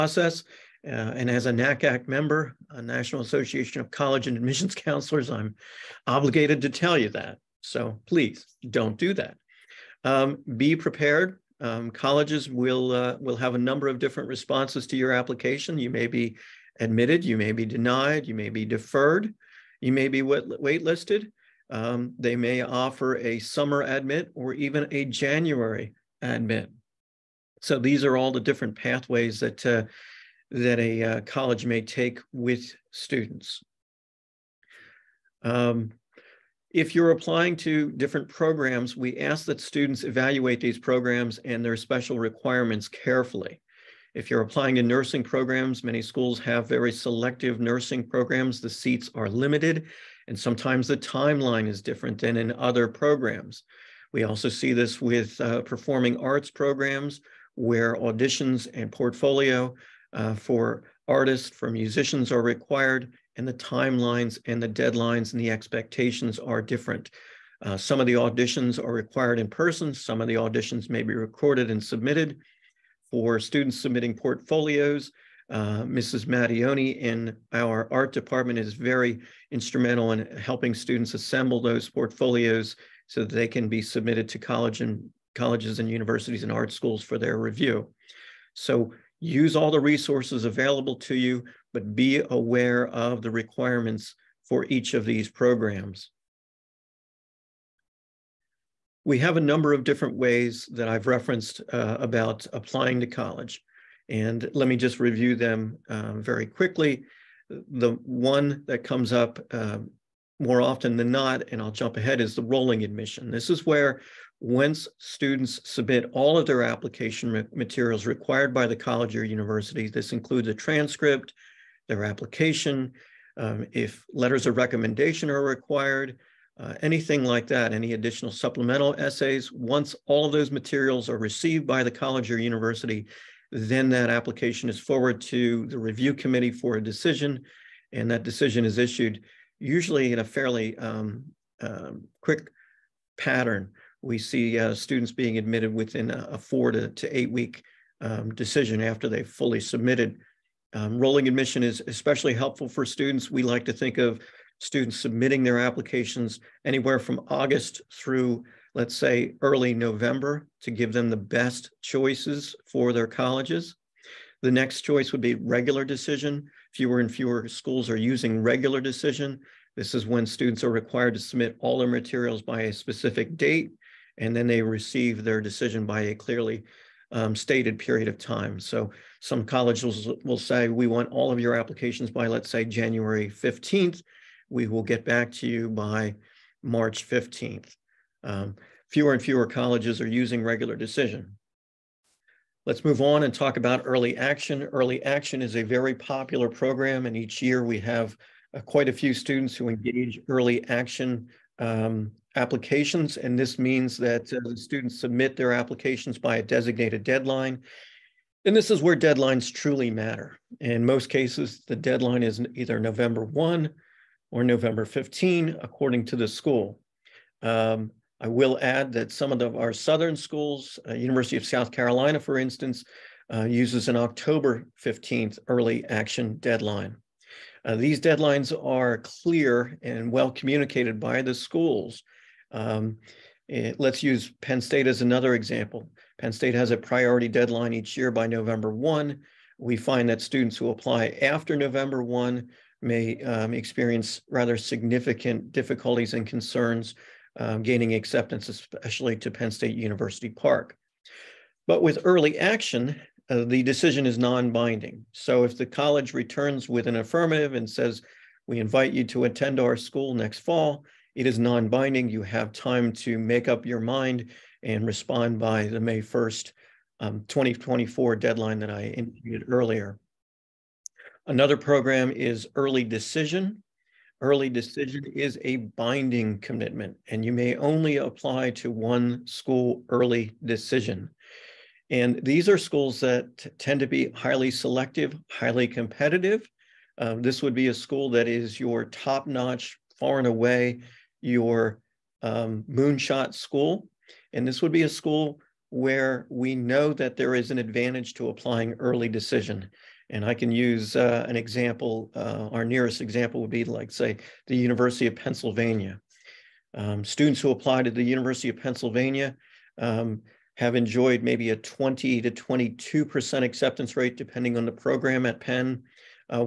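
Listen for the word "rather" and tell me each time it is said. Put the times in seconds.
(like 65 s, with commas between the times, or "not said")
244 s.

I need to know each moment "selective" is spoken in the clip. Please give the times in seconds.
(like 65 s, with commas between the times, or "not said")
46 s, 284 s.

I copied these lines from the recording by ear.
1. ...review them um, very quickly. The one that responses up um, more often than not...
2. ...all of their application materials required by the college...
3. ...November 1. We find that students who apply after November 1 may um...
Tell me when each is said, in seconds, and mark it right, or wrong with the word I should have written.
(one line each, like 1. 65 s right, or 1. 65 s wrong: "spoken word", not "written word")
1. 104 s wrong: "comes", not "responses"
2. 116 s right
3. 238 s right.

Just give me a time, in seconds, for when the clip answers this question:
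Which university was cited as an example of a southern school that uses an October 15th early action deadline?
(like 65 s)
220 s.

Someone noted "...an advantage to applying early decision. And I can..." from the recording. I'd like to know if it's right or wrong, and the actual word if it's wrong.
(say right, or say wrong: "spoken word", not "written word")
right.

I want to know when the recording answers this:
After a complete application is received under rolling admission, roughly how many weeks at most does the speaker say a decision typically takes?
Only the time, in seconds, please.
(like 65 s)
147 s.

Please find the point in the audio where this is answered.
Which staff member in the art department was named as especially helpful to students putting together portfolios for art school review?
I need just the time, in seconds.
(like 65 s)
75 s.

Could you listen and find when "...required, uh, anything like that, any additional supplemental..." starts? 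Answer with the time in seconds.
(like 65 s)
125 s.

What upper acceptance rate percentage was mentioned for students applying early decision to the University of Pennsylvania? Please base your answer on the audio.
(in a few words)
22%.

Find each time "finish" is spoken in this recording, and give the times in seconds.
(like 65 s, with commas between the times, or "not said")
not said.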